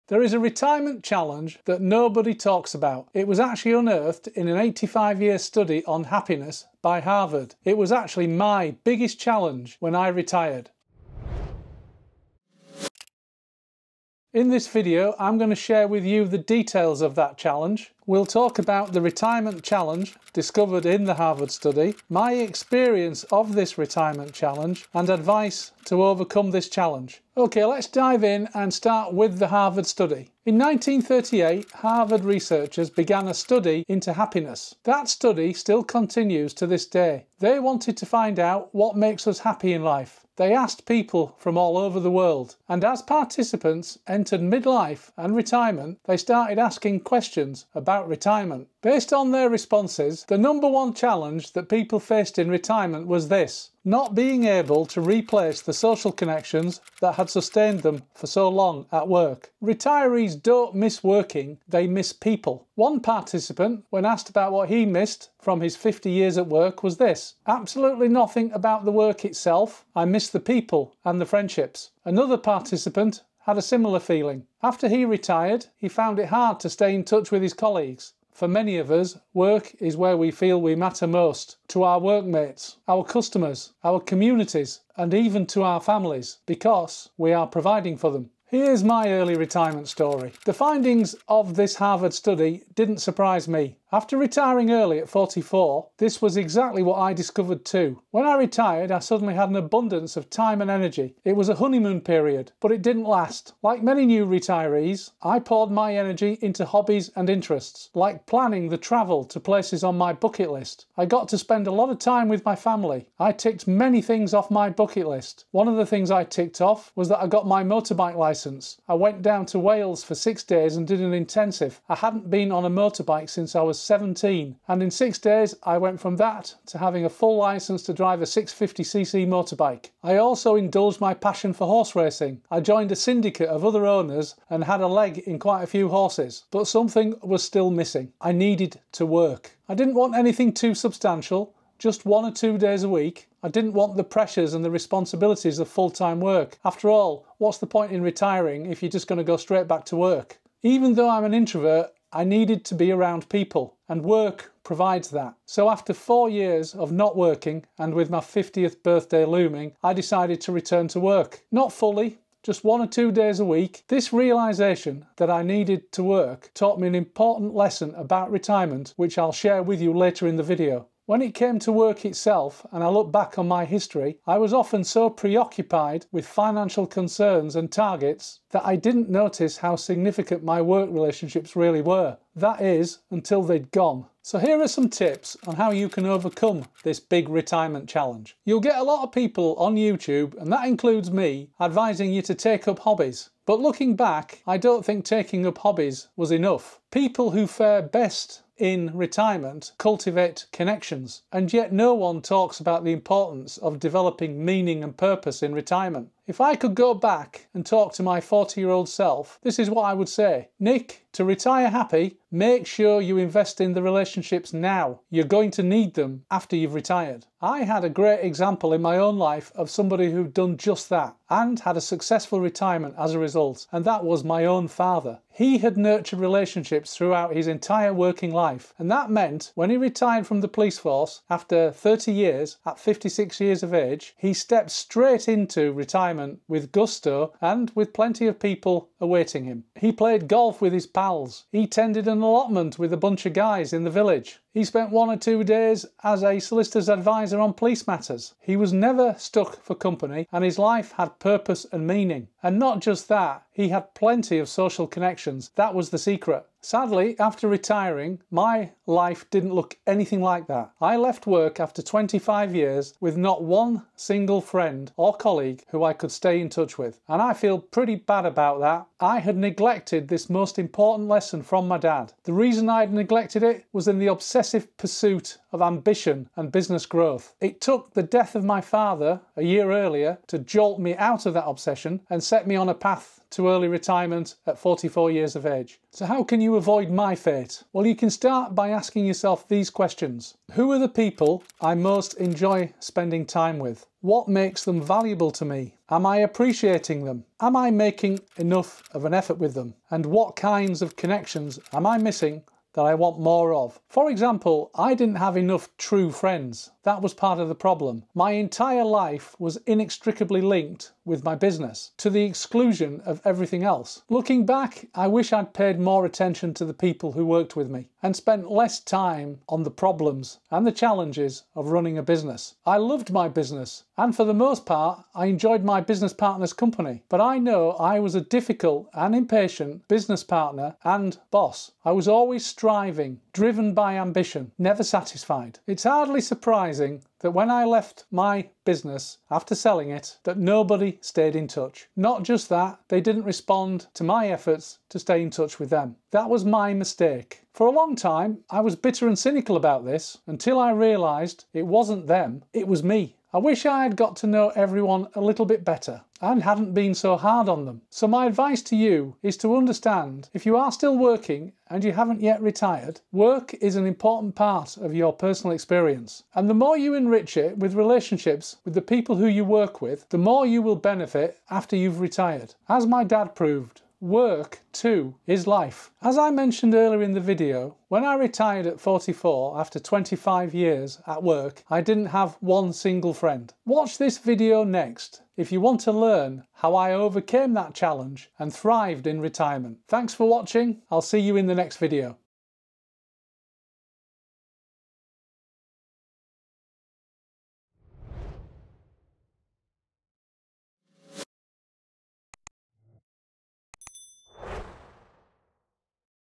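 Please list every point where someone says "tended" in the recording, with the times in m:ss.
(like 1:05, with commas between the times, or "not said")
4:01.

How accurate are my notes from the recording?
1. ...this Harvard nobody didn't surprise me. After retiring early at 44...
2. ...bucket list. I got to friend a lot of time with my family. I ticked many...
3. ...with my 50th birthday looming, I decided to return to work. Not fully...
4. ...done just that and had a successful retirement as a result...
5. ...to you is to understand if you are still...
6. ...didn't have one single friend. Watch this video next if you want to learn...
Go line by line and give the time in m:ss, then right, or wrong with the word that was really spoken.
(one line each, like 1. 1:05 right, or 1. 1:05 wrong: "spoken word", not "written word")
1. 1:31 wrong: "study", not "nobody"
2. 1:50 wrong: "spend", not "friend"
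3. 2:37 right
4. 3:40 right
5. 5:58 right
6. 6:21 right.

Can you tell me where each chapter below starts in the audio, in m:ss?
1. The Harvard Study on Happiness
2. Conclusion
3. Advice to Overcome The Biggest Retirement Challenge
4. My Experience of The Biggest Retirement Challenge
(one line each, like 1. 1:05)
1. 0:30
2. 6:15
3. 3:05
4. 1:29.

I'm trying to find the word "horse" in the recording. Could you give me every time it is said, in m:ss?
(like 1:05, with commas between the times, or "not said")
2:11, 2:15.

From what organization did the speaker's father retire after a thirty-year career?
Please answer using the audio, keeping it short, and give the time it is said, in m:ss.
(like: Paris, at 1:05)
police force, at 3:50.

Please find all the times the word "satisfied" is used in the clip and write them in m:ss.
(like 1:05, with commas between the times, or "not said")
5:34.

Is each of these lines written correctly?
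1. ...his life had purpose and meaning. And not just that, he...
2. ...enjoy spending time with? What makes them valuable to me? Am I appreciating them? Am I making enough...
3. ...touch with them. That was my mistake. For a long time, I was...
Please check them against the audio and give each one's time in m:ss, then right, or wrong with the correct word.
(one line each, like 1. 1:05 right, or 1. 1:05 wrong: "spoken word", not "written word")
1. 4:10 right
2. 4:52 right
3. 5:45 right.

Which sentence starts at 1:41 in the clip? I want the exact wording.
It was a honeymoon period, but it didn't last.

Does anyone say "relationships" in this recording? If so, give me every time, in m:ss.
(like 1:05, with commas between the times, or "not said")
3:00, 3:33, 3:46, 6:07.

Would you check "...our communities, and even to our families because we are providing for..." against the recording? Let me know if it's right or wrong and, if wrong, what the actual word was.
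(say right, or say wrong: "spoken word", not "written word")
right.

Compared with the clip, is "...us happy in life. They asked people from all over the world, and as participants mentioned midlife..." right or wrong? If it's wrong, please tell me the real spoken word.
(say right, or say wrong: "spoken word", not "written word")
wrong: "entered", not "mentioned".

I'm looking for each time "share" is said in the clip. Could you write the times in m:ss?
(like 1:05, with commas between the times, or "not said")
0:15, 2:49.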